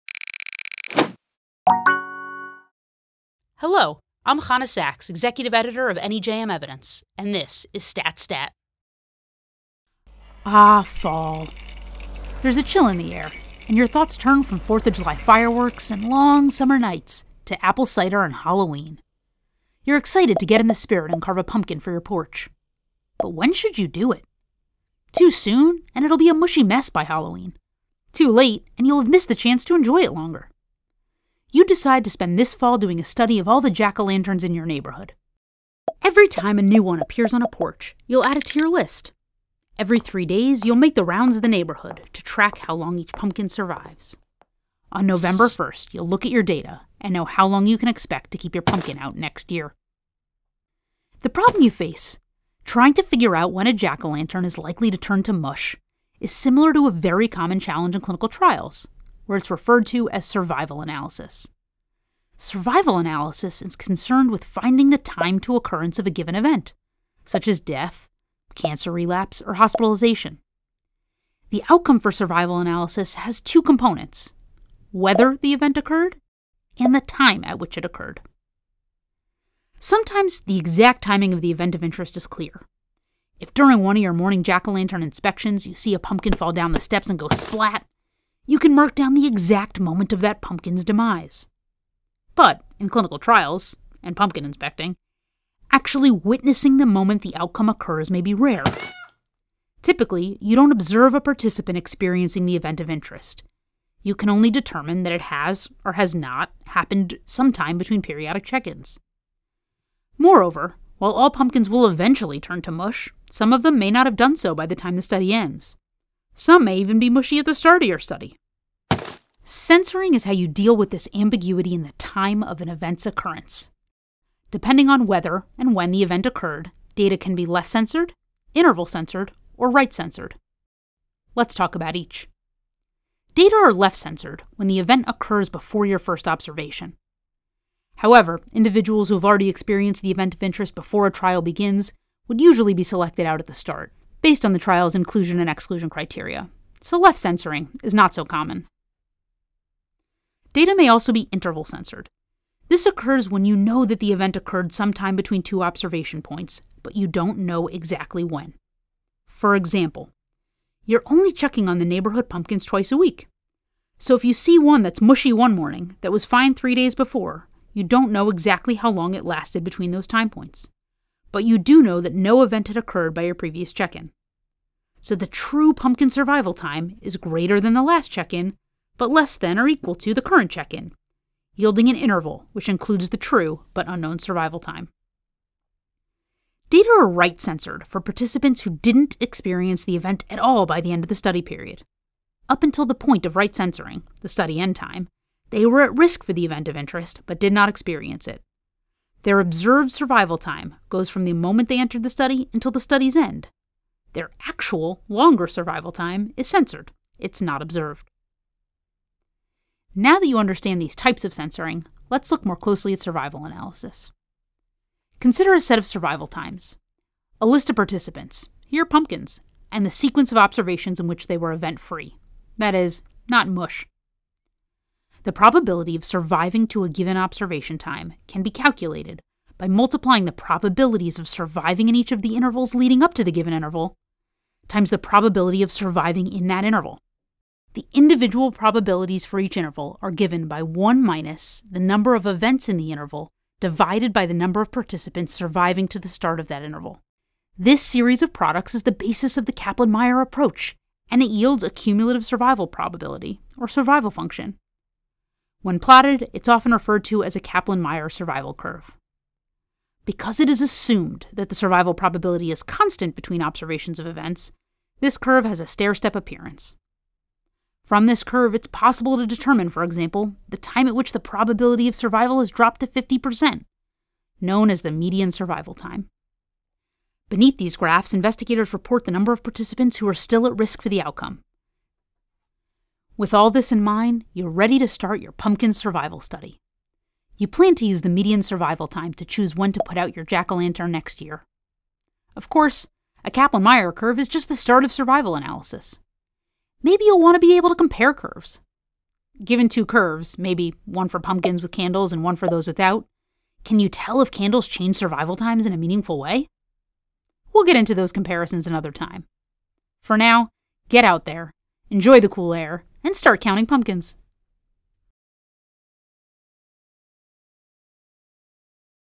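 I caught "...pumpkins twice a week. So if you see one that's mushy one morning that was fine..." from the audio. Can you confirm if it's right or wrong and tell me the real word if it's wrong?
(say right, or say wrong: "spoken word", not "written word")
right.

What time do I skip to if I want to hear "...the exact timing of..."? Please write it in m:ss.
1:20.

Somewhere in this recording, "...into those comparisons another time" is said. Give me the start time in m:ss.
5:07.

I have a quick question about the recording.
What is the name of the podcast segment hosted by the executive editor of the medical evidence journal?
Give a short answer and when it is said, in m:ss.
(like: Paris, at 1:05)
Stat Stat, at 0:07.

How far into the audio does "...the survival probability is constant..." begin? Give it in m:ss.
4:21.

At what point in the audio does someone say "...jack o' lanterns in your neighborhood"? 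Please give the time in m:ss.
0:33.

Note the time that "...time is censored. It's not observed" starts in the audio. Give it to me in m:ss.
3:25.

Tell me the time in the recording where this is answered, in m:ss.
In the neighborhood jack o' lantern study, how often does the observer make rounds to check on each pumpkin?
0:39.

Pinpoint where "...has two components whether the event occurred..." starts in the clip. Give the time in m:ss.
1:13.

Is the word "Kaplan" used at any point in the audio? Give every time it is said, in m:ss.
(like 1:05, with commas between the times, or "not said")
4:09, 4:17, 4:53.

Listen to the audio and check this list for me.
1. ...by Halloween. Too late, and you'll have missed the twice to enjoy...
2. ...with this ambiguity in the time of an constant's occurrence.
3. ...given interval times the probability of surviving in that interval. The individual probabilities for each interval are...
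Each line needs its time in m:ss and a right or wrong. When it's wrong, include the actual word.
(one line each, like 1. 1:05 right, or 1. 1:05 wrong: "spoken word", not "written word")
1. 0:26 wrong: "chance", not "twice"
2. 2:00 wrong: "event", not "constant"
3. 3:53 right.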